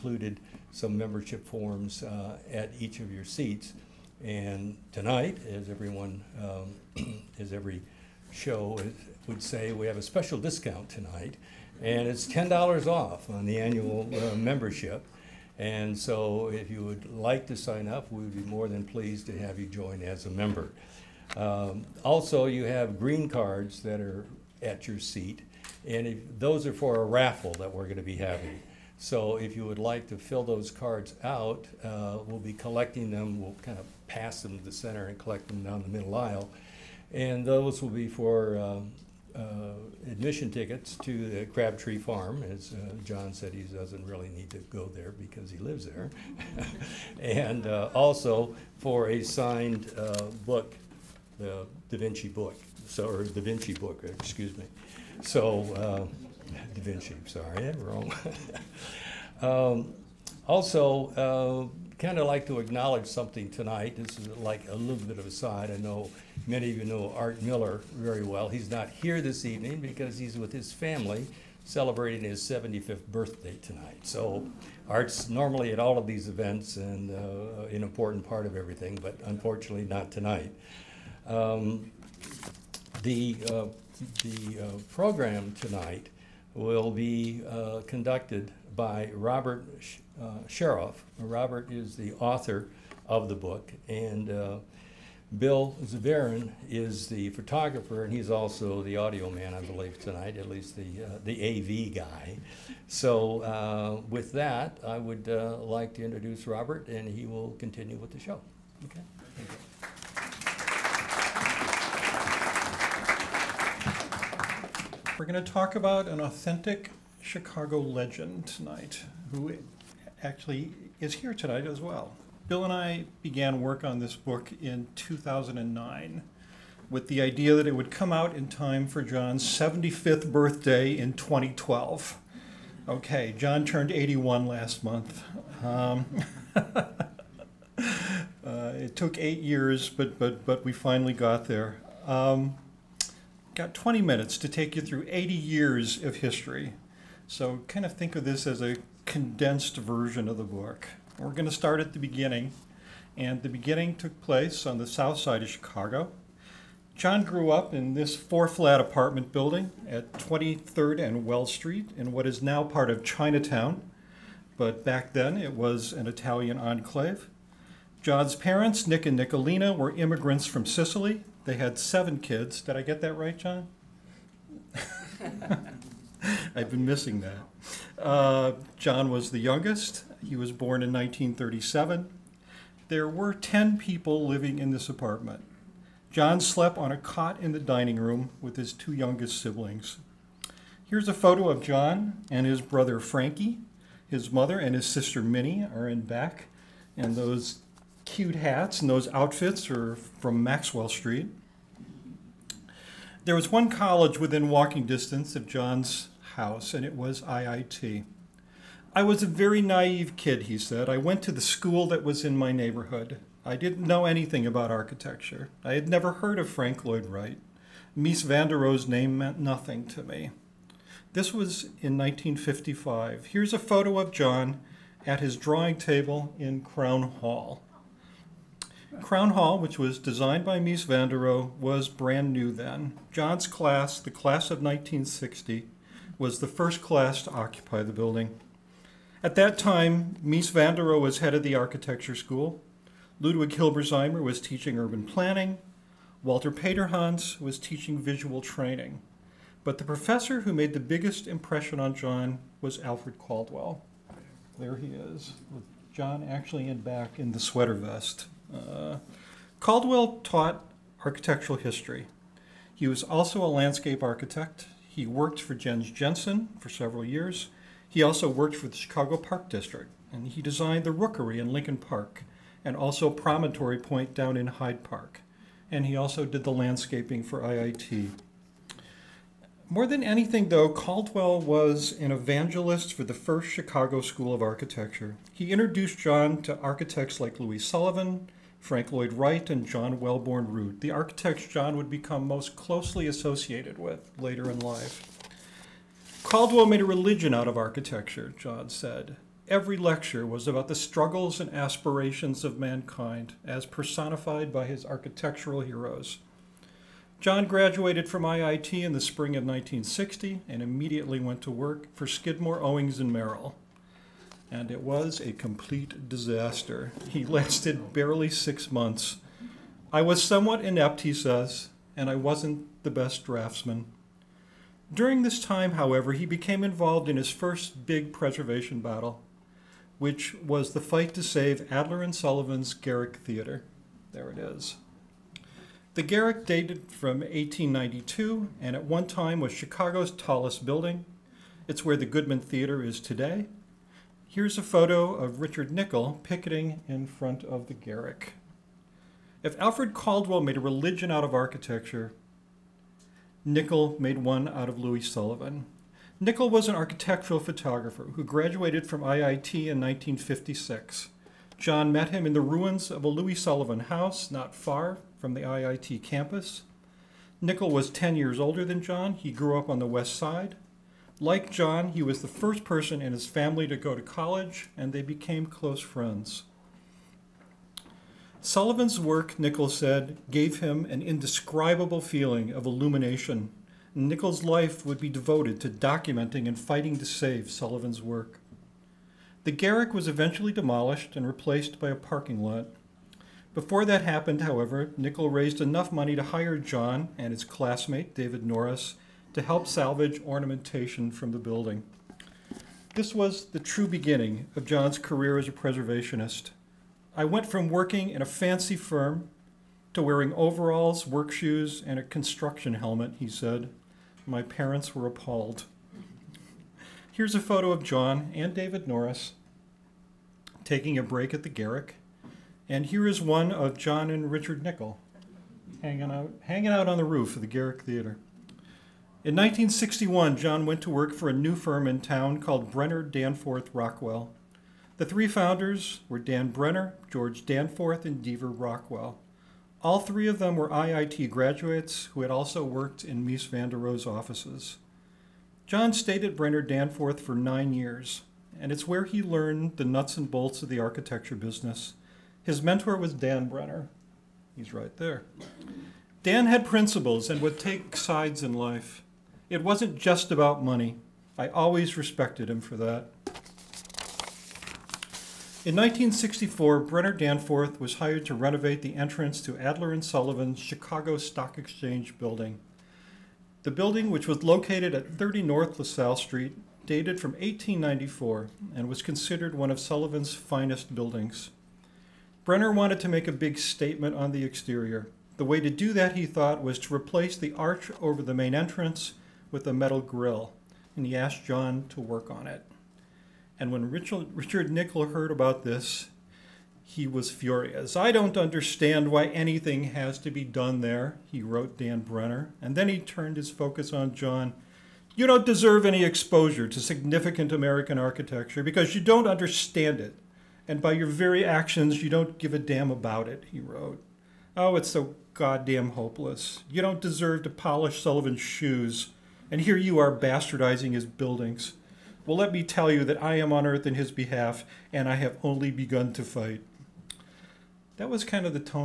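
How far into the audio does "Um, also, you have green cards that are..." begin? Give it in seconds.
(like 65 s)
21 s.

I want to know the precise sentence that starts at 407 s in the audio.
I went from working in a fancy firm to wearing overalls, work shoes, and a construction helmet, he said.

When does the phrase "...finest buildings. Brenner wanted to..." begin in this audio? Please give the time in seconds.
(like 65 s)
480 s.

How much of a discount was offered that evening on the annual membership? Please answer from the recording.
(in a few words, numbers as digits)
$10.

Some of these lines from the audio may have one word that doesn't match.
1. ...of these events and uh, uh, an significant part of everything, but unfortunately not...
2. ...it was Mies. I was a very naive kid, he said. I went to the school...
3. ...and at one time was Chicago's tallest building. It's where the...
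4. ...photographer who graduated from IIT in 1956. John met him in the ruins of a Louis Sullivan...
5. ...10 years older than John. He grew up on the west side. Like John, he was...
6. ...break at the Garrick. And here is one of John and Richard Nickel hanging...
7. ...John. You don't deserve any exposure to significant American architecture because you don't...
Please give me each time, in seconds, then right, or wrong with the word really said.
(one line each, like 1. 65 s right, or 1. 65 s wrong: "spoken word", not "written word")
1. 75 s wrong: "important", not "significant"
2. 206 s wrong: "IIT", not "Mies"
3. 338 s right
4. 357 s right
5. 367 s right
6. 421 s right
7. 504 s right.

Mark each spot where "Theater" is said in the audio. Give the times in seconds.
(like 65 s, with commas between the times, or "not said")
333 s, 342 s, 427 s.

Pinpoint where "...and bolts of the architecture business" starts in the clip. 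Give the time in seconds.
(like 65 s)
450 s.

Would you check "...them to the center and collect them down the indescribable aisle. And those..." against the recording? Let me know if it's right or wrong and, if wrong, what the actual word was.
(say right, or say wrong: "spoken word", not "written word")
wrong: "middle", not "indescribable".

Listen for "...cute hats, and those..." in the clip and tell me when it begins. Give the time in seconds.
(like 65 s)
198 s.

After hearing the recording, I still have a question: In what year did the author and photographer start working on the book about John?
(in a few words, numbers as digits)
2009.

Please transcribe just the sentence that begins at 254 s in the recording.
There he is, with John actually in back in the sweater vest.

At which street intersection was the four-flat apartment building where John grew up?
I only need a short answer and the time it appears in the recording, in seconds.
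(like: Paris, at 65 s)
23rd and Wells Street, at 160 s.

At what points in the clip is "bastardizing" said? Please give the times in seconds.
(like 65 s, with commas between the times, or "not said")
520 s.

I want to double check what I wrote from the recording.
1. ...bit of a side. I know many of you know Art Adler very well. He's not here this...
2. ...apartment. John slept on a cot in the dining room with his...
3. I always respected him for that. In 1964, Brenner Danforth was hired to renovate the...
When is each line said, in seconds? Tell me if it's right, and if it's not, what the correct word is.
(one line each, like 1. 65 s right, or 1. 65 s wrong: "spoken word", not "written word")
1. 65 s wrong: "Miller", not "Adler"
2. 184 s right
3. 461 s right.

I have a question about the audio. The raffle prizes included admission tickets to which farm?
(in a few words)
Crabtree Farm.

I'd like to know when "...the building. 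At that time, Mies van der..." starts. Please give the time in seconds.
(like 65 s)
237 s.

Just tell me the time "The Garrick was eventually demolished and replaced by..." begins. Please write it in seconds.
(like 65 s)
389 s.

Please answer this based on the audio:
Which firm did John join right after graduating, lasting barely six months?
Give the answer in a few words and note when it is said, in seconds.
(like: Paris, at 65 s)
Skidmore, Owings, and Merrill, at 312 s.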